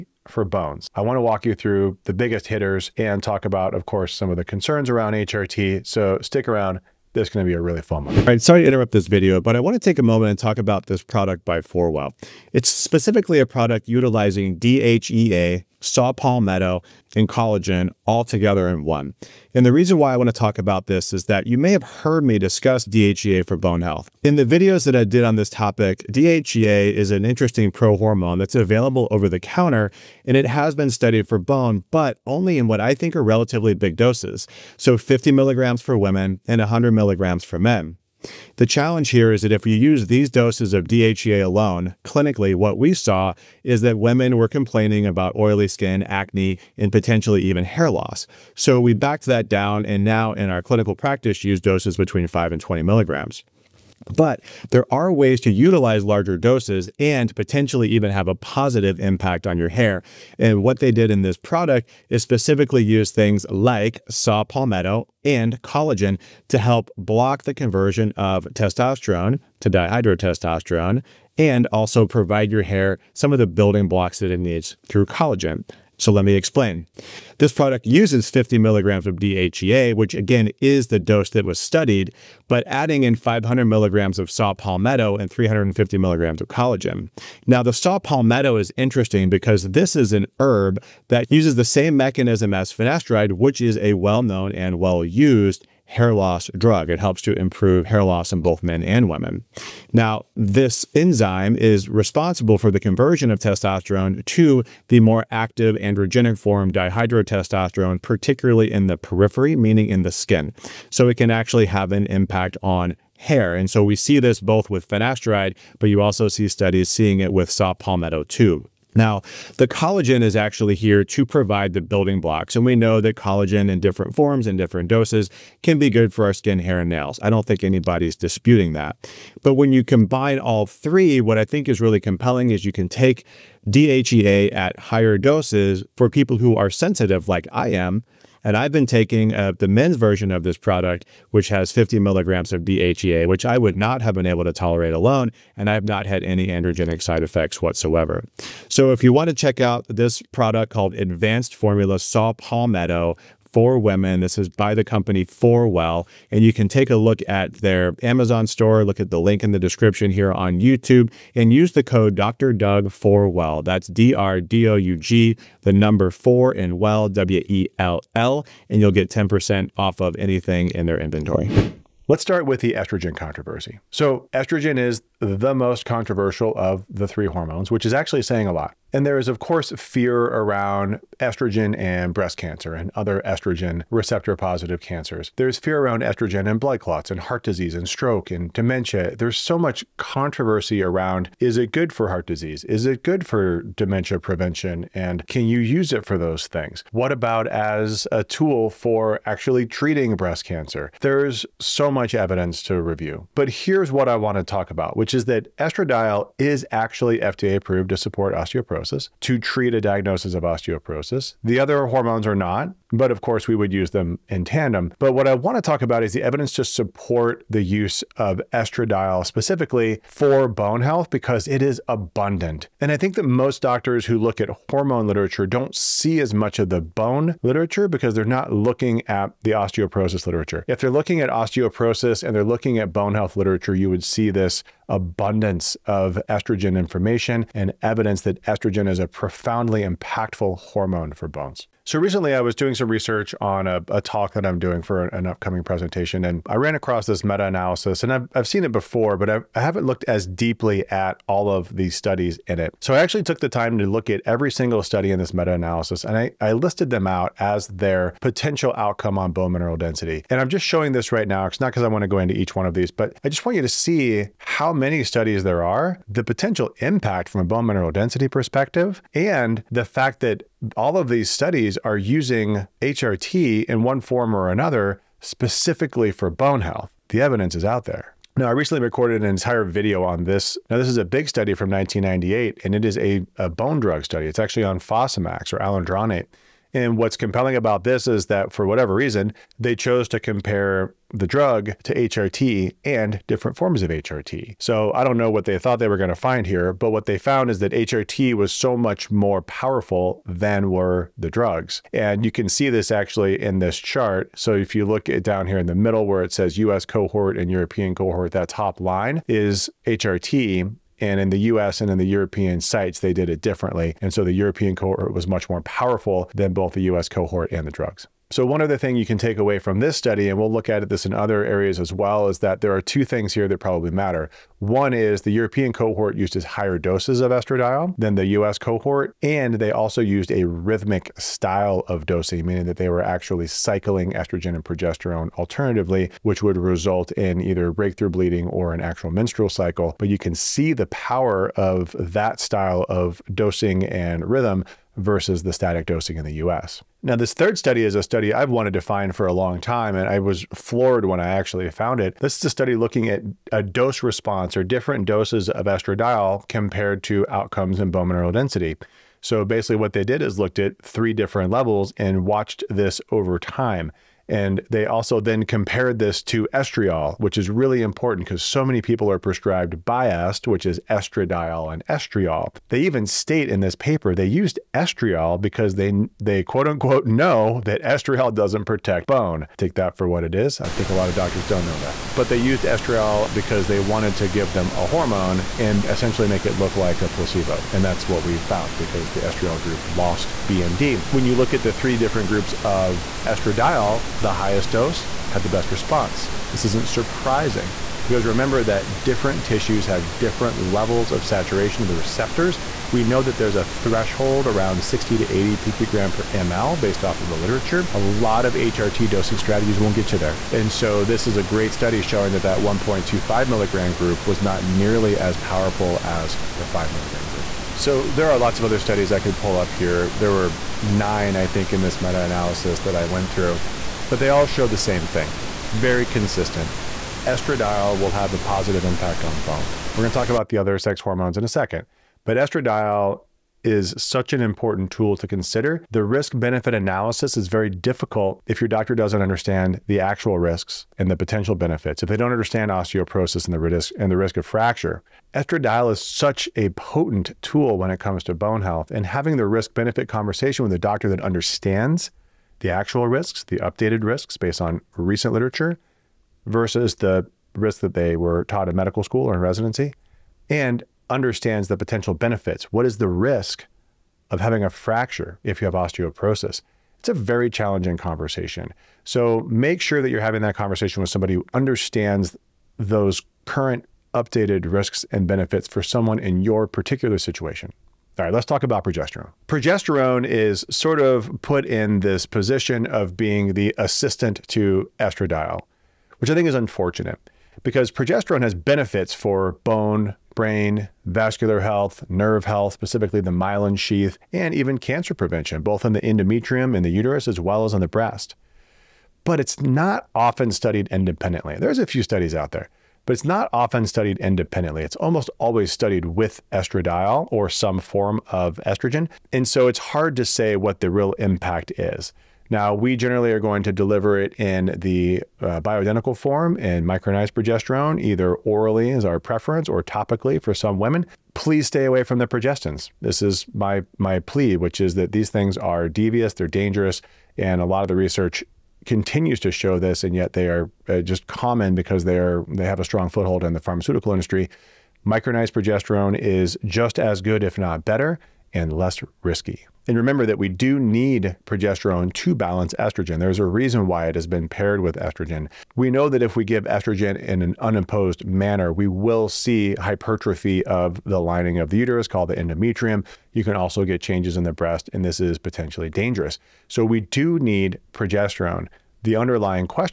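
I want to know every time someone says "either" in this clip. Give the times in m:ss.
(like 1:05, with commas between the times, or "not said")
5:37, 8:38.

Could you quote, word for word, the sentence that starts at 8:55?
Micronized progesterone is just as good, if not better, and less risky.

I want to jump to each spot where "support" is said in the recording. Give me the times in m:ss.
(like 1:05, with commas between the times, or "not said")
3:27, 3:36.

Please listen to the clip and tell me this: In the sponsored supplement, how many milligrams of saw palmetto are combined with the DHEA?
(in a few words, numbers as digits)
500 milligrams.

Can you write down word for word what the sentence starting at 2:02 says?
And we know that collagen in different forms and different doses can be good for our skin, hair, and nails.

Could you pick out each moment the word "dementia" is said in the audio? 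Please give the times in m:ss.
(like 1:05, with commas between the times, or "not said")
3:08, 3:13.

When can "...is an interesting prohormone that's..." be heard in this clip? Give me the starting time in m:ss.
0:26.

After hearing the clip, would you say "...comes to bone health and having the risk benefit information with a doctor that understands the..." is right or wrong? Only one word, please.
wrong.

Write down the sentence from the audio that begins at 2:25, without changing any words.
And I have not had any androgenic side effects whatsoever.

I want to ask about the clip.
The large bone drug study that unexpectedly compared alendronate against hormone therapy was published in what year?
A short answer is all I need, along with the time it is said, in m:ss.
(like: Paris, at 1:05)
1998, at 4:41.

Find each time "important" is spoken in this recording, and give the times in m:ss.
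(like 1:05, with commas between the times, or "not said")
6:07, 7:14.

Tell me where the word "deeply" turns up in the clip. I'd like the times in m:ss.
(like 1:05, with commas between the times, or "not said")
4:10.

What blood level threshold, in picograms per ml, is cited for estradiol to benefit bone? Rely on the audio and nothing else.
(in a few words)
60 to 80.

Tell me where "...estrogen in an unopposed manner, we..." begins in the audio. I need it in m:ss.
9:06.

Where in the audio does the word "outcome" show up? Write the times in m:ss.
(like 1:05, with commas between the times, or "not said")
4:18, 5:57.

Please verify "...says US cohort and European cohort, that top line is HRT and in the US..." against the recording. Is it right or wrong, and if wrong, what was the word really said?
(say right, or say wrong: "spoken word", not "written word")
right.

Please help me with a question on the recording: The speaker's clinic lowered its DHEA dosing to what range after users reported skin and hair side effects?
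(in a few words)
5 to 20 milligrams.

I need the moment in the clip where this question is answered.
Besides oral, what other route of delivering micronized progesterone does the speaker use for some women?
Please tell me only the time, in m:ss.
8:39.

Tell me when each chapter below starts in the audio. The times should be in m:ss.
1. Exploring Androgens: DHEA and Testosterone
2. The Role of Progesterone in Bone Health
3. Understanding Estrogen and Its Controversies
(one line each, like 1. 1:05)
1. 8:34
2. 5:52
3. 2:35.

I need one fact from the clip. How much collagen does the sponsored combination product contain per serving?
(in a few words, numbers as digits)
350 milligrams.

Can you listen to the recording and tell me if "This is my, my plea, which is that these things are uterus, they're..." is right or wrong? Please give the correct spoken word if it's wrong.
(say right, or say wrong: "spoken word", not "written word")
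wrong: "devious", not "uterus".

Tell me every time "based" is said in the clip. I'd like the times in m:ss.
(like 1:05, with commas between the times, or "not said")
6:46, 7:34.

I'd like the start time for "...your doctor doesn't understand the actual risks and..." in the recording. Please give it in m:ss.
7:18.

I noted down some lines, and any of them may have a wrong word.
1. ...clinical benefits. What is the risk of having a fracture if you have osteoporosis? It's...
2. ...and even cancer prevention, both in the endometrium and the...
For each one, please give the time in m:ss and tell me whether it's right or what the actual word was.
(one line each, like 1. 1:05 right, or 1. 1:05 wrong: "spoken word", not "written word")
1. 7:41 wrong: "potential", not "clinical"
2. 8:14 right.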